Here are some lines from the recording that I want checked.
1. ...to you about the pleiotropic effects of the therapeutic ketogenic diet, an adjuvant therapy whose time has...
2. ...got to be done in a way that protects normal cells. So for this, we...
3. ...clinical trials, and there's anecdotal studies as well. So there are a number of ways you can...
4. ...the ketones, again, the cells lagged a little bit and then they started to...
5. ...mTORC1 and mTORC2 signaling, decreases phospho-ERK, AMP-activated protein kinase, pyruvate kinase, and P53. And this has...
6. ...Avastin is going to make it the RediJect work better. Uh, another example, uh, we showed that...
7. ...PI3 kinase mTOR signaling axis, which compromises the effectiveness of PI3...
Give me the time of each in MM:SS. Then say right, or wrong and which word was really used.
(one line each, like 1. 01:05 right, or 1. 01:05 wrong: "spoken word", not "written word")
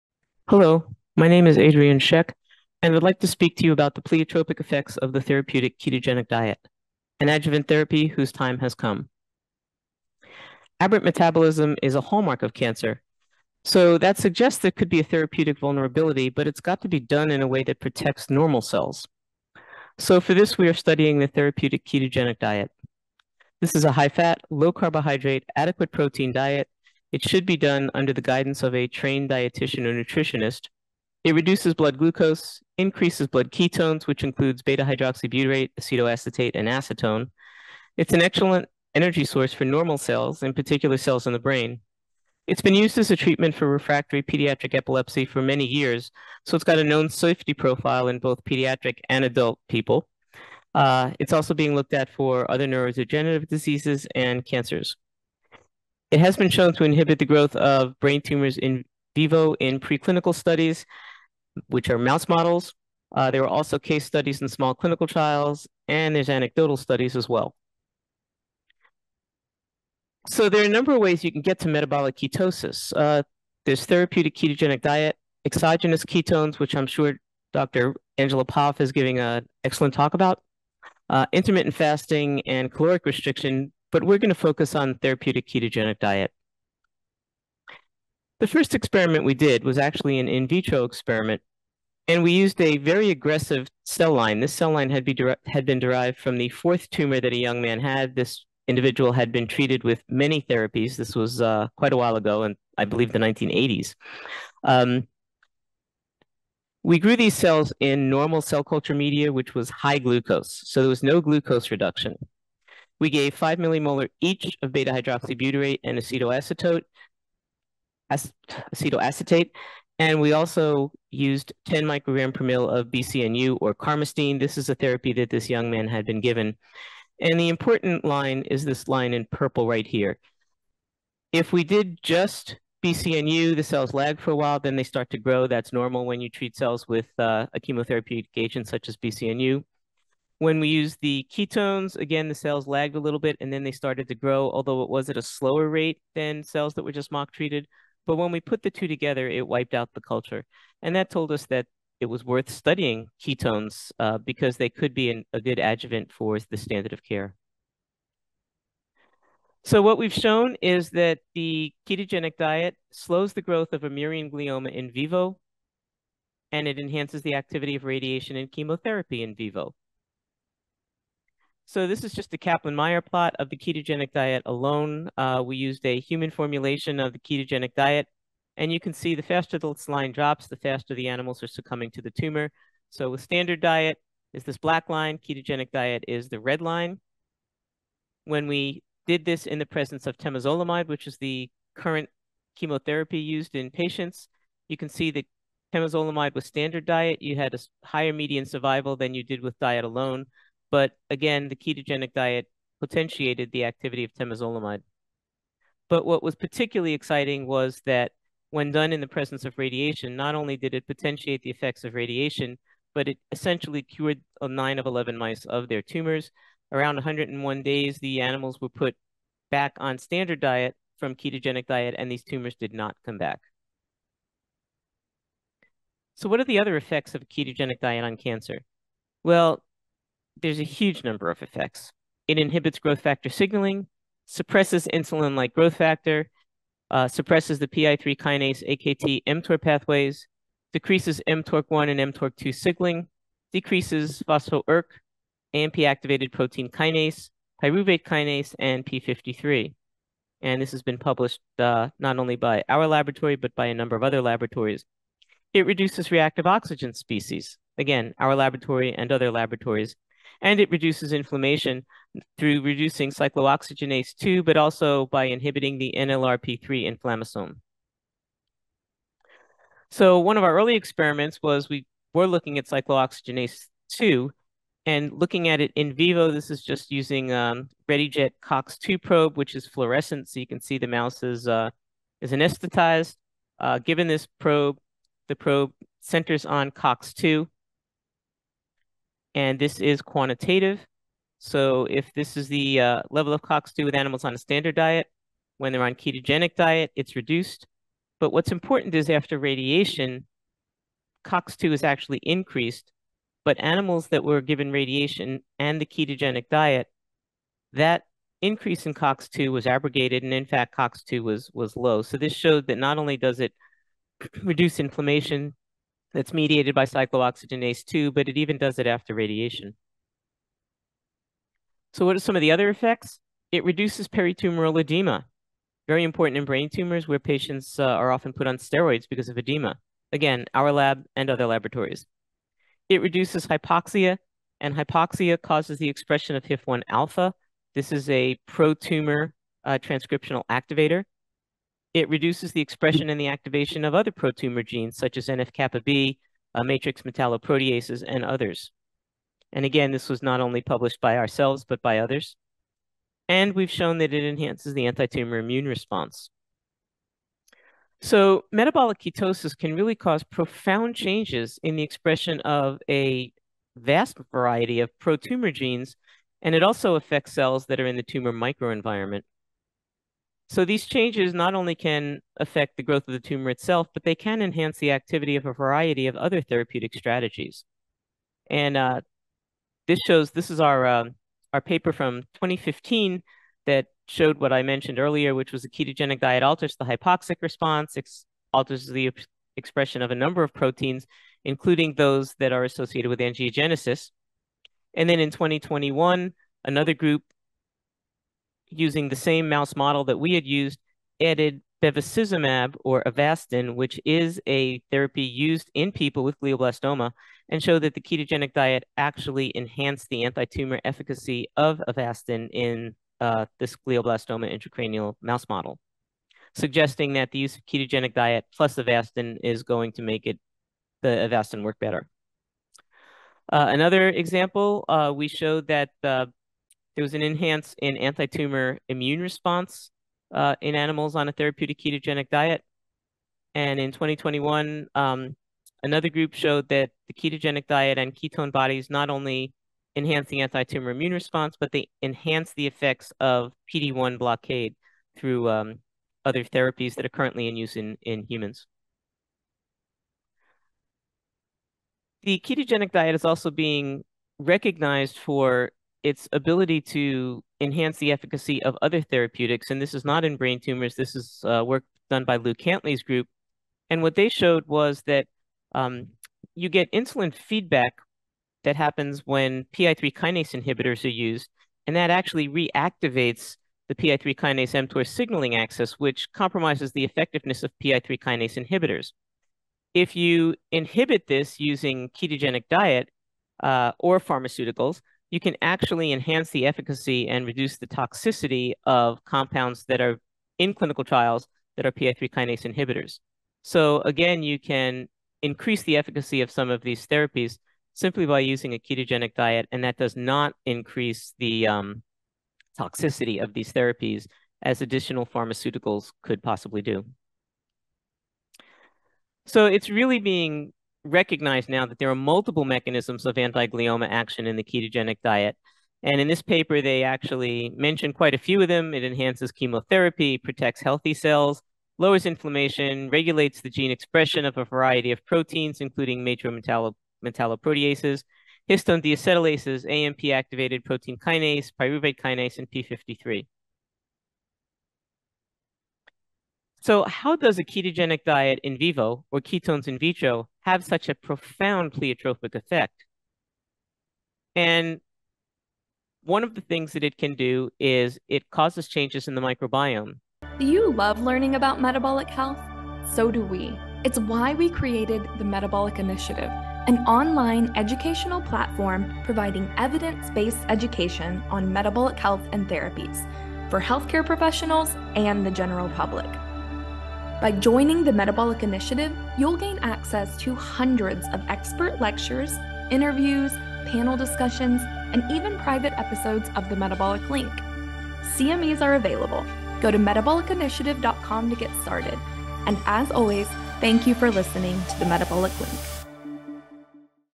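1. 00:03 right
2. 00:16 right
3. 01:04 right
4. 02:21 right
5. 04:01 right
6. 06:58 wrong: "Avastin", not "RediJect"
7. 07:53 right.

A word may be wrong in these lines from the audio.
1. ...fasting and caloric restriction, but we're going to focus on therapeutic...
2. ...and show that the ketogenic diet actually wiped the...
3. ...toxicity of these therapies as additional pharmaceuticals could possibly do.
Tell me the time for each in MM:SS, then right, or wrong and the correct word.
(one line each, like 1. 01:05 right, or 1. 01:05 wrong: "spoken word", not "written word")
1. 01:21 right
2. 06:47 wrong: "enhanced", not "wiped"
3. 08:22 right.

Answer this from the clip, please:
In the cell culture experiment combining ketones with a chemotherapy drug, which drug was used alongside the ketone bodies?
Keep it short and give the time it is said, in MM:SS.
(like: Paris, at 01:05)
carmustine, at 02:03.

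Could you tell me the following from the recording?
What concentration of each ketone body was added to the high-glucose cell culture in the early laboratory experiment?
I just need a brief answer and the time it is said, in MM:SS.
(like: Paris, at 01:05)
5 millimolar, at 01:53.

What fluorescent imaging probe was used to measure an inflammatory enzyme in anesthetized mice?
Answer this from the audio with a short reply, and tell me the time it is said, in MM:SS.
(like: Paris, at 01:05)
RediJect COX-2 probe, at 04:37.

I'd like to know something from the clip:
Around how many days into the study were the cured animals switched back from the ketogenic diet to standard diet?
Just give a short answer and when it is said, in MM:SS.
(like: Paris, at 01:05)
101 days, at 03:36.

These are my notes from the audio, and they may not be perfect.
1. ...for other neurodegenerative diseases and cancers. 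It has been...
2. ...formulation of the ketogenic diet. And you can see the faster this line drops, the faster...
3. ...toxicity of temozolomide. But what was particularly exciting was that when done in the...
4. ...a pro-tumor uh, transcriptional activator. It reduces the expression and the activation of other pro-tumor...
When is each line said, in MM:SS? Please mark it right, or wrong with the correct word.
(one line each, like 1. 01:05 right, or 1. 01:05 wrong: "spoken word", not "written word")
1. 00:52 right
2. 02:56 right
3. 03:23 wrong: "activity", not "toxicity"
4. 05:38 right.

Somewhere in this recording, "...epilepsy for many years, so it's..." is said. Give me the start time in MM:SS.
00:44.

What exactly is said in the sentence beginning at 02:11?
If we did just BCNU, the cells lag for a while, then they start to grow.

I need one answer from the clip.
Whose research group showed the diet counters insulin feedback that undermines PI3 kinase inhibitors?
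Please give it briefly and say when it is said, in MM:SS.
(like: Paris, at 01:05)
Lew Cantley, at 07:42.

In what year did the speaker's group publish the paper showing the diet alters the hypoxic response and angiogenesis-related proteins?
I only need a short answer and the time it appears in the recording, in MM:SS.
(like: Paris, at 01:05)
2015, at 06:22.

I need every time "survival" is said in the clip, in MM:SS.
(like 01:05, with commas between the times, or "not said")
03:18.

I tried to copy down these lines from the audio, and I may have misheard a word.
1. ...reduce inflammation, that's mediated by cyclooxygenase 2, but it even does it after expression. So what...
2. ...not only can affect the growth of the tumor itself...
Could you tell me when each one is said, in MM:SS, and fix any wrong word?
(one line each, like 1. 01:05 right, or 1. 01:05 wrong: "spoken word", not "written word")
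1. 05:14 wrong: "radiation", not "expression"
2. 06:11 right.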